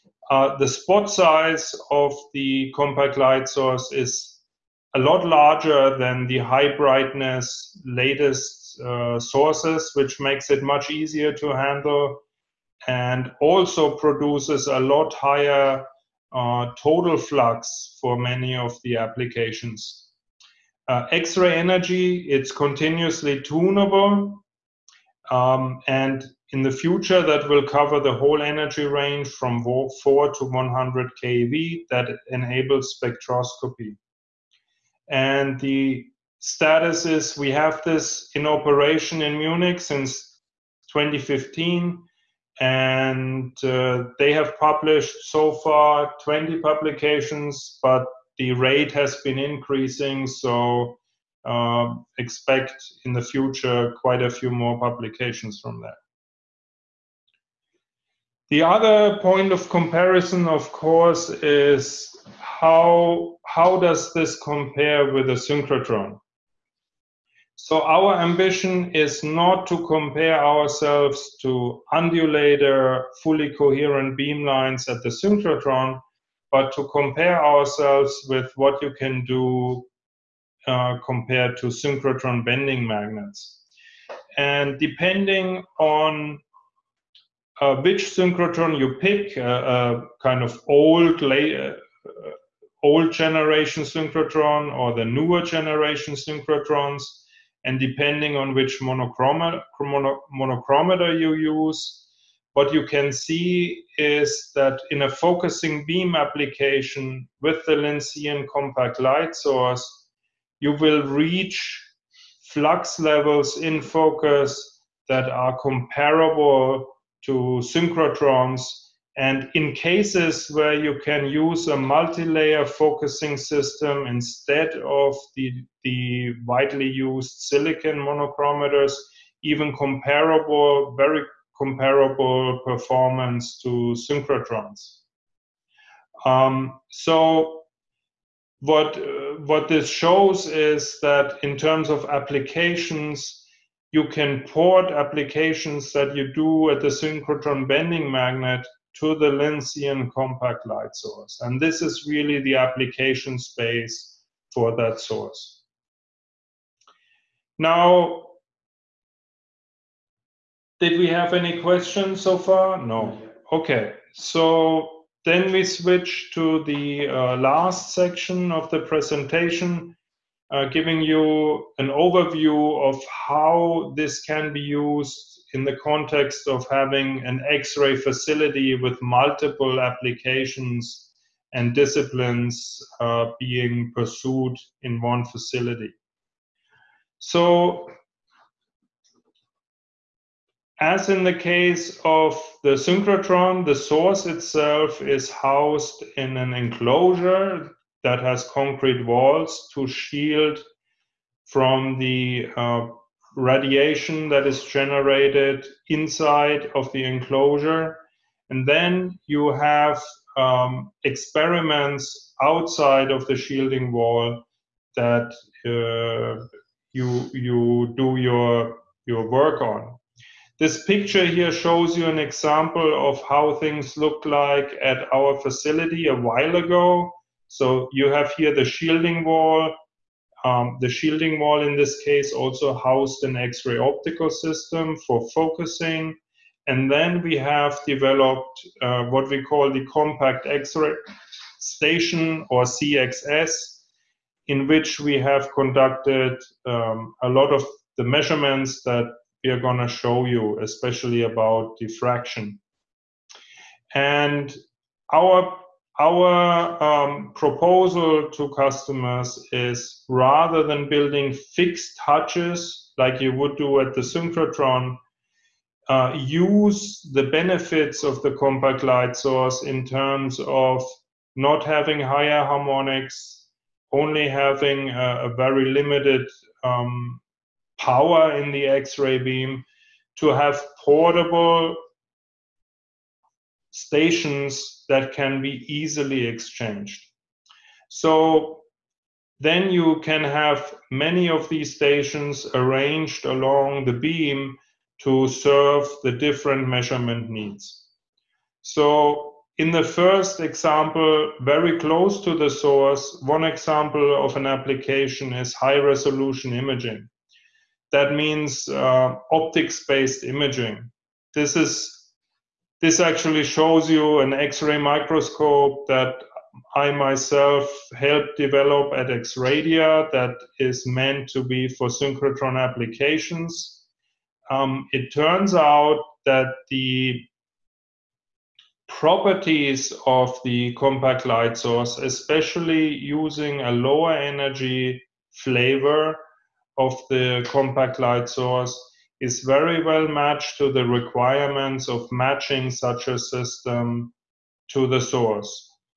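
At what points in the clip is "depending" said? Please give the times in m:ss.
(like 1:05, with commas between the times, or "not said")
1:24, 1:37.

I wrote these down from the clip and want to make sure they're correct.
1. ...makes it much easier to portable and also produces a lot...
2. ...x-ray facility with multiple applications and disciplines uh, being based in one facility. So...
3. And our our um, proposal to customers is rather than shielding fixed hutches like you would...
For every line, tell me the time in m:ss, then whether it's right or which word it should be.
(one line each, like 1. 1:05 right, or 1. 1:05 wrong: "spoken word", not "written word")
1. 0:10 wrong: "handle", not "portable"
2. 2:57 wrong: "pursued", not "based"
3. 4:13 wrong: "building", not "shielding".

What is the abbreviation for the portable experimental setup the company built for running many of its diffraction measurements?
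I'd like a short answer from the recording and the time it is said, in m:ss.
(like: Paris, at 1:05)
CXS, at 4:02.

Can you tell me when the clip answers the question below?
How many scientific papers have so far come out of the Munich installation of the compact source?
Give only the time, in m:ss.
0:46.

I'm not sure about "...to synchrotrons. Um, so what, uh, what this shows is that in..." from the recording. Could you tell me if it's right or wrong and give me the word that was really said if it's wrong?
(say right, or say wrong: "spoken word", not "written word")
right.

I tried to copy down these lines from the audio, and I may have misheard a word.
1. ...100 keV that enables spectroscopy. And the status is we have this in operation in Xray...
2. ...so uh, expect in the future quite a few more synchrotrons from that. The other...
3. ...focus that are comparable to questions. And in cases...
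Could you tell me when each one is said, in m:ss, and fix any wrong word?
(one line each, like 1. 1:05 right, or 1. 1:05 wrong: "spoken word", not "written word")
1. 0:30 wrong: "Munich", not "Xray"
2. 0:50 wrong: "publications", not "synchrotrons"
3. 1:53 wrong: "synchrotrons", not "questions".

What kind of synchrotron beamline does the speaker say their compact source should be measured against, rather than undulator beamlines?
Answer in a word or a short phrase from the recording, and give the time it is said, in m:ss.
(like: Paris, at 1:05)
Bending magnets, at 1:21.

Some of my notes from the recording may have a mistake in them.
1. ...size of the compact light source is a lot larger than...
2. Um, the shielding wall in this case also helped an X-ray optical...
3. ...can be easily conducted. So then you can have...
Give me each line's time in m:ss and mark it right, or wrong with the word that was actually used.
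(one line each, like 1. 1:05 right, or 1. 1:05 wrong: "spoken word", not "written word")
1. 0:01 right
2. 3:50 wrong: "housed", not "helped"
3. 4:45 wrong: "exchanged", not "conducted".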